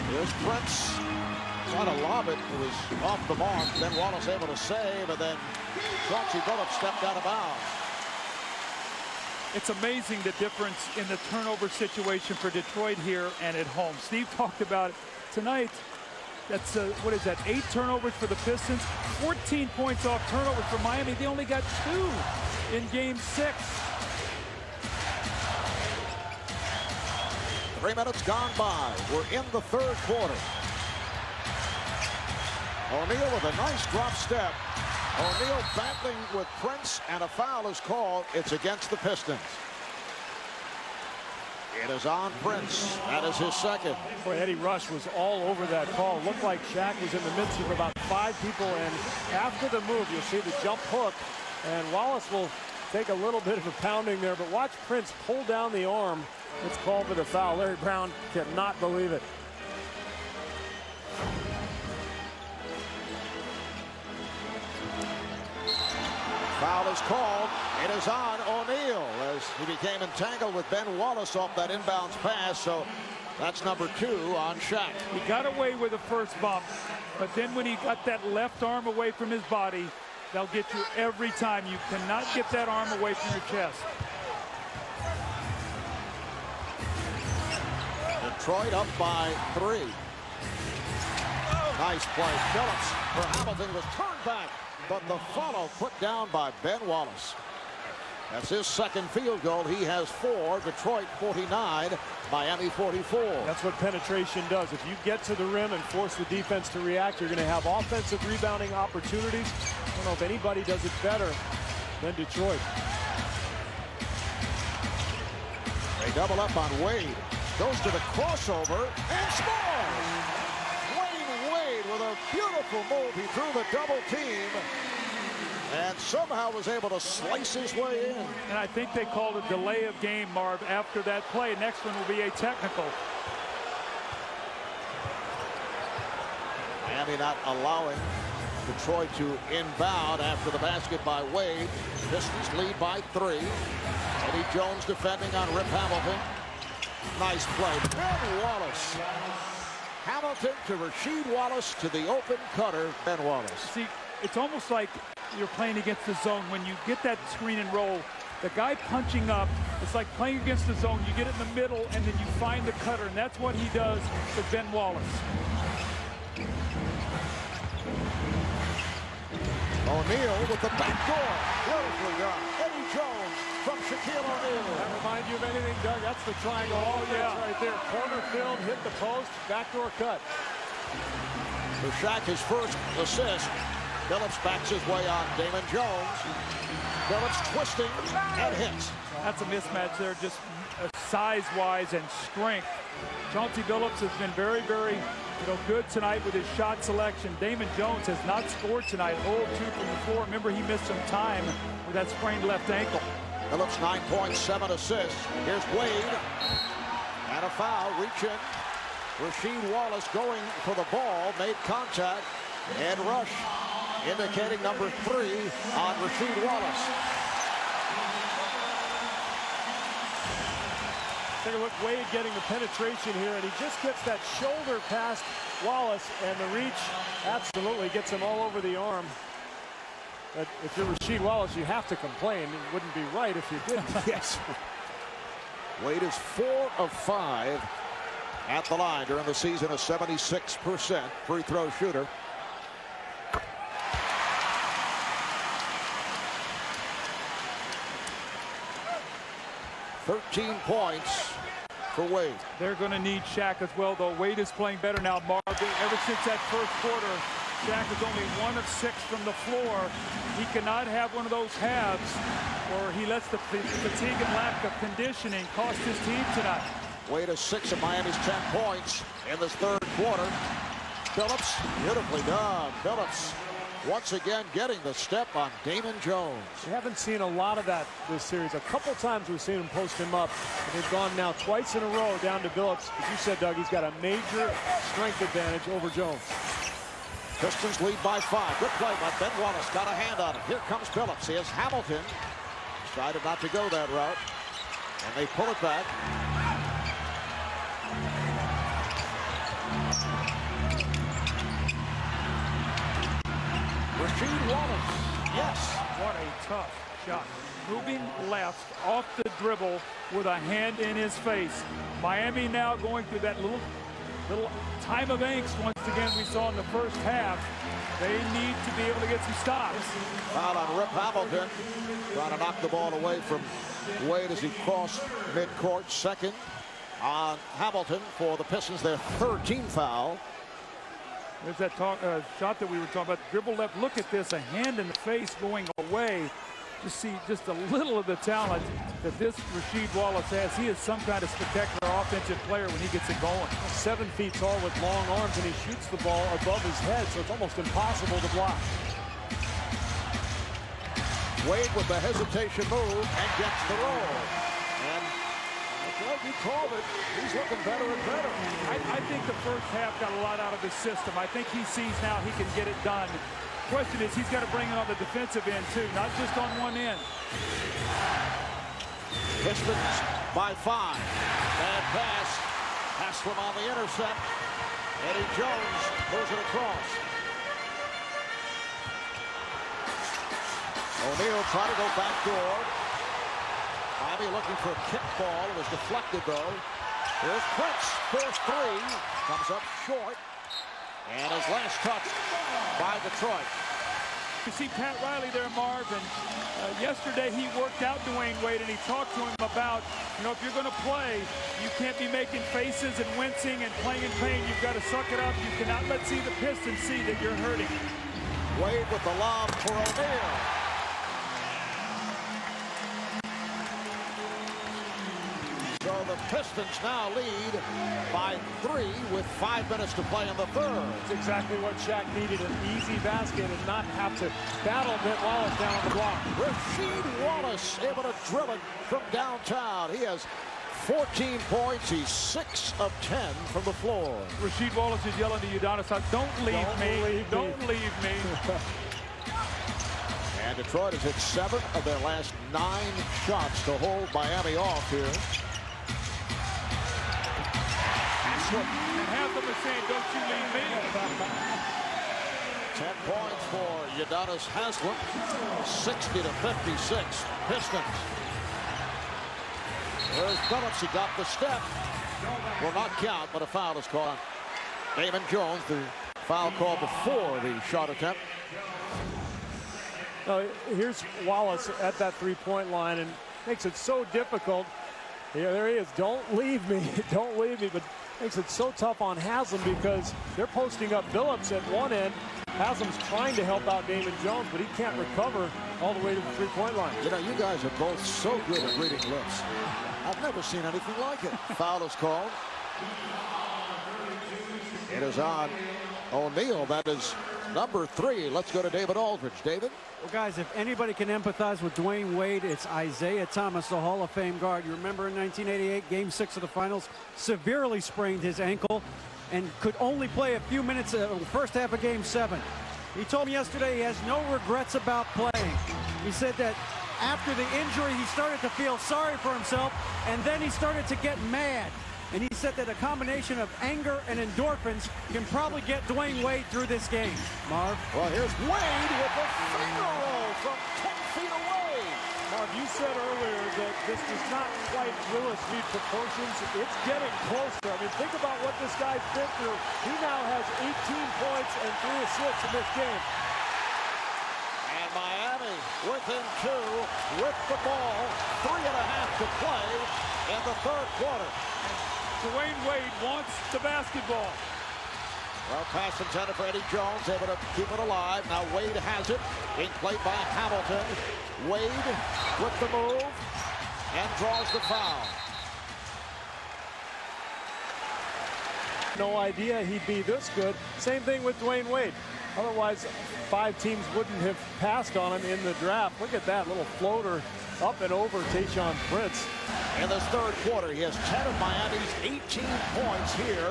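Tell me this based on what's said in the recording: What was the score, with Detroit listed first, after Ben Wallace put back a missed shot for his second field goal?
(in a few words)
49-44.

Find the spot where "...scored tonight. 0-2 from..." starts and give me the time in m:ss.
3:18.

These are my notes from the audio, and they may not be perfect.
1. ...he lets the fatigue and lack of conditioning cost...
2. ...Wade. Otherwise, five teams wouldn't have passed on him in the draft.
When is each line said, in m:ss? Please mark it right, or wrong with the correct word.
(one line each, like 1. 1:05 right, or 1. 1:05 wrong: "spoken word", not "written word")
1. 4:22 right
2. 9:31 right.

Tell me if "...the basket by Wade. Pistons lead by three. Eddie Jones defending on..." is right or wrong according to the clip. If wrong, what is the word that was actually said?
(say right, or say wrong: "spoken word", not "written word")
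right.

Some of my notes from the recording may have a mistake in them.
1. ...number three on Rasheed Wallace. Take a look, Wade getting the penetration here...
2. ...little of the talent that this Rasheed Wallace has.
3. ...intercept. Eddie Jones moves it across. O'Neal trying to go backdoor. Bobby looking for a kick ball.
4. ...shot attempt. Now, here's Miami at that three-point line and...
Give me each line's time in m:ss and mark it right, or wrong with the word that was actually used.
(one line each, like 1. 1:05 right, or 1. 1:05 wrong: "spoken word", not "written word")
1. 3:34 right
2. 5:37 right
3. 6:13 right
4. 7:47 wrong: "Wallace", not "Miami".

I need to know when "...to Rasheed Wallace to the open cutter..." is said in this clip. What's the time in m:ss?
2:30.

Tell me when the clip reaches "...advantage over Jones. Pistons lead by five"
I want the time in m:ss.
4:45.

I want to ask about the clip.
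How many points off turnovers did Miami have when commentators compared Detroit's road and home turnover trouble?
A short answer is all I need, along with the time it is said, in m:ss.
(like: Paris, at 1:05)
14, at 0:19.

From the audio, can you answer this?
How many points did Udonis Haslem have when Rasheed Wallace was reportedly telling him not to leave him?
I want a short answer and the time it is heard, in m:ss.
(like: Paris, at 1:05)
10, at 7:32.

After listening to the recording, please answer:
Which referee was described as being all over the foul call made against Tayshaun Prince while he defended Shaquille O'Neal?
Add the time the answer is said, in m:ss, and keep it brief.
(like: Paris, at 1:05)
Eddie Rush, at 0:44.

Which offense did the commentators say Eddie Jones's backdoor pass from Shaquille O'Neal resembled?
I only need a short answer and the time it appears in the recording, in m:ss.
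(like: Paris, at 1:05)
The triangle, at 2:56.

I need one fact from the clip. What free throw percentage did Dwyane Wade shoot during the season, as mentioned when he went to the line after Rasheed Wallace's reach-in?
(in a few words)
76%.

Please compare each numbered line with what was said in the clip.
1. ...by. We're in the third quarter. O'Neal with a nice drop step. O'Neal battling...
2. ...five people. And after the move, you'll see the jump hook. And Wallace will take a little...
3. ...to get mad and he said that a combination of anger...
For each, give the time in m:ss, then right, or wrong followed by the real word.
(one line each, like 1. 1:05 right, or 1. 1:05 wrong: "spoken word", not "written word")
1. 0:28 right
2. 0:47 right
3. 8:40 right.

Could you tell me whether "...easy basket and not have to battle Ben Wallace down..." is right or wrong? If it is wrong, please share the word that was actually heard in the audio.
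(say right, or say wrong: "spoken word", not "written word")
right.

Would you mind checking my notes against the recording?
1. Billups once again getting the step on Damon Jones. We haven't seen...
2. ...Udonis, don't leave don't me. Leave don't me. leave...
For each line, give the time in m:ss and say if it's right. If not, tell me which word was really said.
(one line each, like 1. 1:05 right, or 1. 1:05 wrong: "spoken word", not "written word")
1. 4:32 right
2. 7:15 right.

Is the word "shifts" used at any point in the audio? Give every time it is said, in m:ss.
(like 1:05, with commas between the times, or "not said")
not said.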